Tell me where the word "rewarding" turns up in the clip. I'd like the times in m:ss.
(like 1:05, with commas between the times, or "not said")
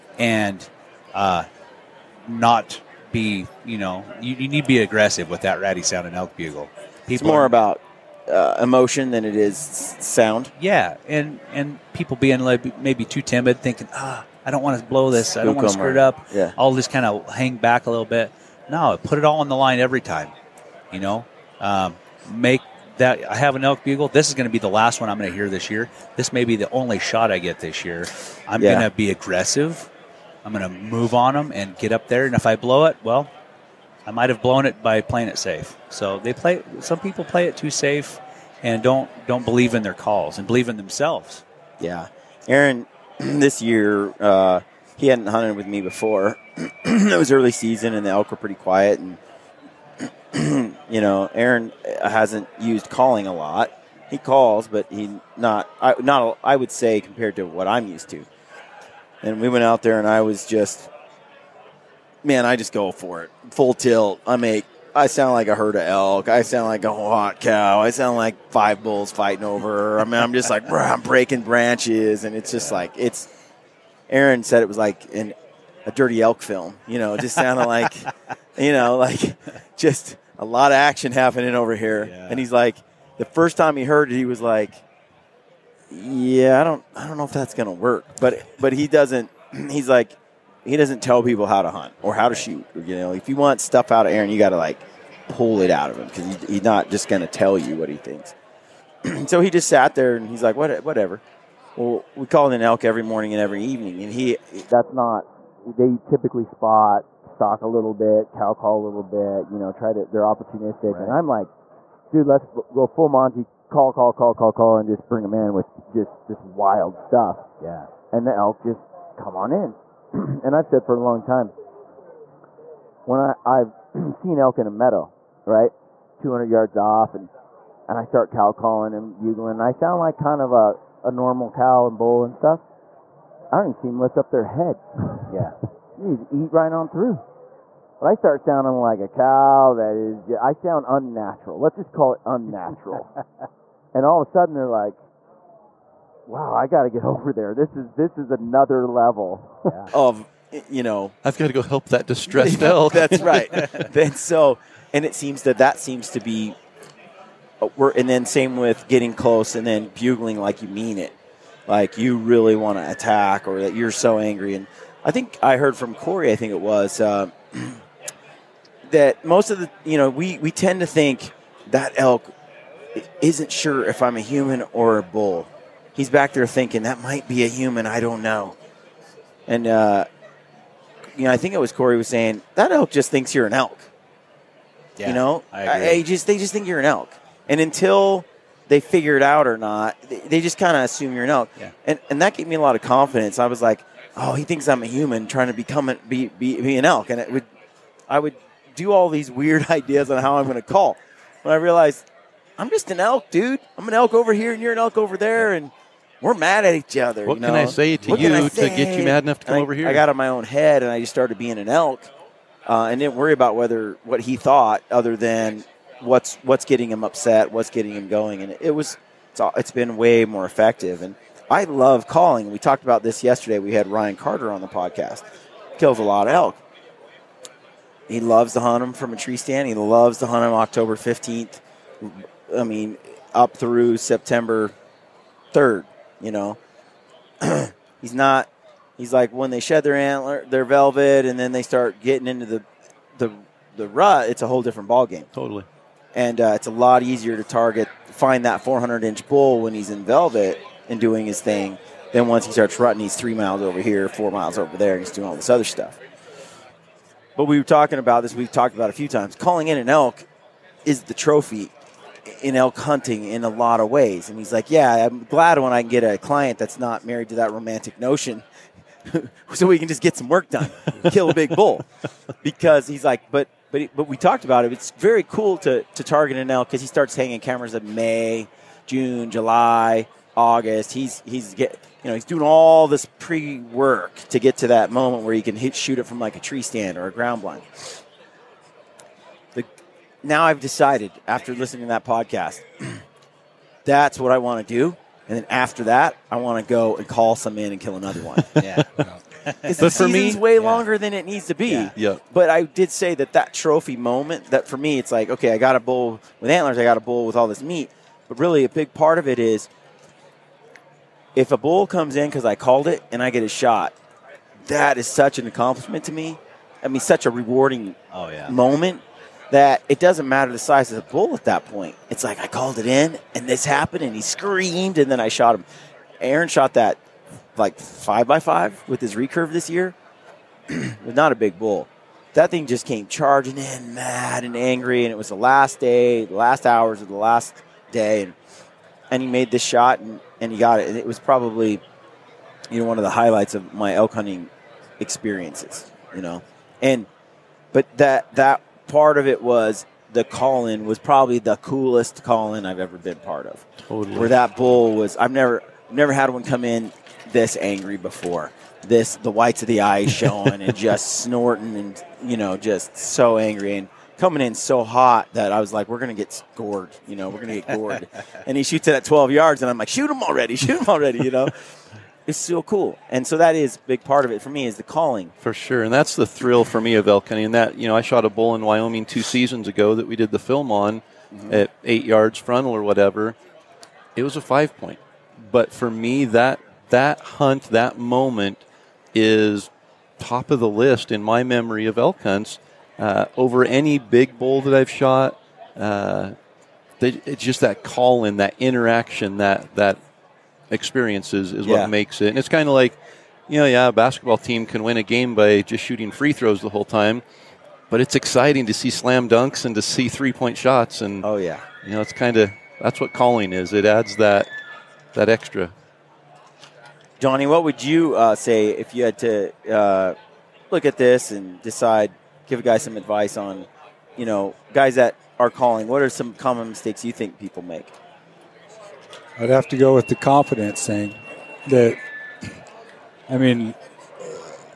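5:17.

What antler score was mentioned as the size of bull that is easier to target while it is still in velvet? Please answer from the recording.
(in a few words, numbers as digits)
400 inch.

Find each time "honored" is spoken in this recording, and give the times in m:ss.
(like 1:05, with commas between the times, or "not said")
not said.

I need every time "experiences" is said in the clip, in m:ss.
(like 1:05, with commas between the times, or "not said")
5:44, 6:40.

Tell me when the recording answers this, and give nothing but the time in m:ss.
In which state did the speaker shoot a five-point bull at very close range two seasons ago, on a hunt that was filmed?
6:18.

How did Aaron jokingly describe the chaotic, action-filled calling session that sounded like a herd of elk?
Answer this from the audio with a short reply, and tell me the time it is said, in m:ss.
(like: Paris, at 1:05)
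a dirty elk film, at 1:15.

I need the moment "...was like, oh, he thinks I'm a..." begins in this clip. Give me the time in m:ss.
3:13.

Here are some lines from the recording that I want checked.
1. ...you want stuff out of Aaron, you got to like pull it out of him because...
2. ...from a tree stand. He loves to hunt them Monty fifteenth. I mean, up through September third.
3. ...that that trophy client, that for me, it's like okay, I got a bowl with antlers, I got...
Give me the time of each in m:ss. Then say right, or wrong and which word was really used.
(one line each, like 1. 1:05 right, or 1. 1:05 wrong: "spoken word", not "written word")
1. 1:33 right
2. 3:48 wrong: "October", not "Monty"
3. 5:03 wrong: "moment", not "client".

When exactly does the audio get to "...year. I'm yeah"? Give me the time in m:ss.
0:27.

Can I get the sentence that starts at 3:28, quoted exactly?
to get you mad enough to come I, over here?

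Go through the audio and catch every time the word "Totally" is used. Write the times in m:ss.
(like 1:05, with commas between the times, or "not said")
4:05, 5:53.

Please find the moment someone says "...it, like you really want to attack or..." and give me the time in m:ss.
2:40.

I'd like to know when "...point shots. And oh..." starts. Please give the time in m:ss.
6:50.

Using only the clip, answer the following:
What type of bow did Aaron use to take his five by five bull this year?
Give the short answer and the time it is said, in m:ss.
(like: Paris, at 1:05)
recurve, at 5:29.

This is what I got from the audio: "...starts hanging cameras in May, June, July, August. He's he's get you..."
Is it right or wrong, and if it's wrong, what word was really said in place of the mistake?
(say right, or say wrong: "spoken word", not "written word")
right.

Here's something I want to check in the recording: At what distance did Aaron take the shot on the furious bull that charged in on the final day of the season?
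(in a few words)
12 yards.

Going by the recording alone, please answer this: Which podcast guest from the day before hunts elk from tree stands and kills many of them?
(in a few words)
Ryan Carter.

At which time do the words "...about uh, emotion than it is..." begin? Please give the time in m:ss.
0:07.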